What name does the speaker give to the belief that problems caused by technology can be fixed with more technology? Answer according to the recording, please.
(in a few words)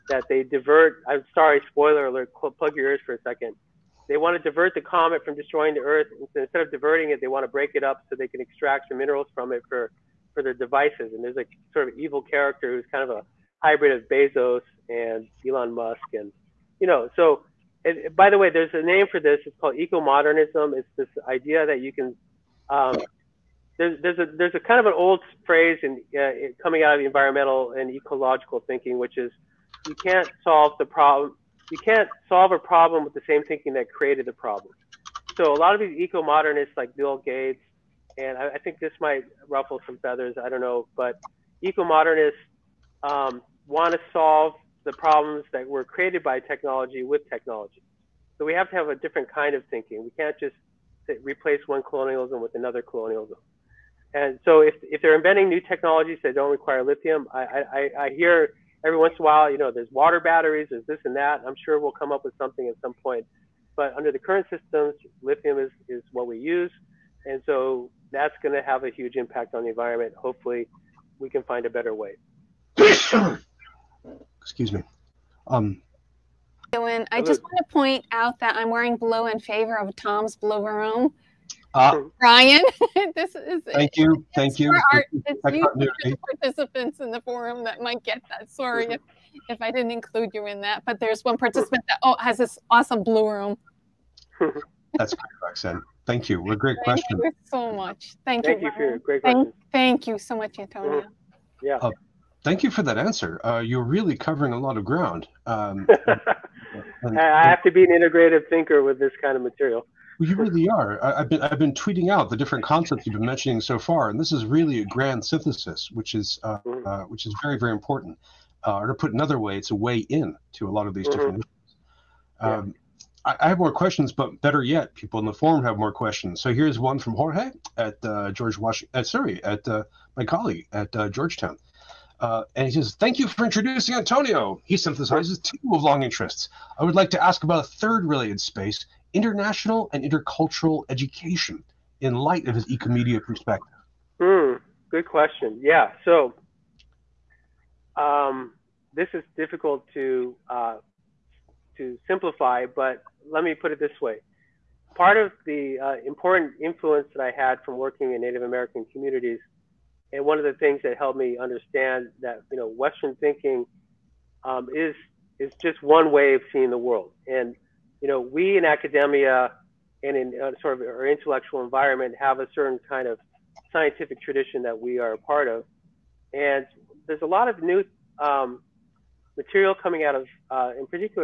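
Eco-modernism.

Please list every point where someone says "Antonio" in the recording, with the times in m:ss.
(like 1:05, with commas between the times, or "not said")
1:40, 2:13.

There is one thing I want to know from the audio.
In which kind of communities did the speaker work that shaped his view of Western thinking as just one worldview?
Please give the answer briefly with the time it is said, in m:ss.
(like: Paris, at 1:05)
Native American communities, at 2:38.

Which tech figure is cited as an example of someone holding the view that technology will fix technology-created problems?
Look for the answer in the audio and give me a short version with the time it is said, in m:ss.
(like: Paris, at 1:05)
Bill Gates, at 0:36.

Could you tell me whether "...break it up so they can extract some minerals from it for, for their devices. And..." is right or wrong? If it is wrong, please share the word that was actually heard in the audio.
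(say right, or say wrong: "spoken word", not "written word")
right.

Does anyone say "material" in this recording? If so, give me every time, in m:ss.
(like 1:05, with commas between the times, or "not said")
1:49, 2:59.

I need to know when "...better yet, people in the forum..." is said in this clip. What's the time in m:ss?
2:04.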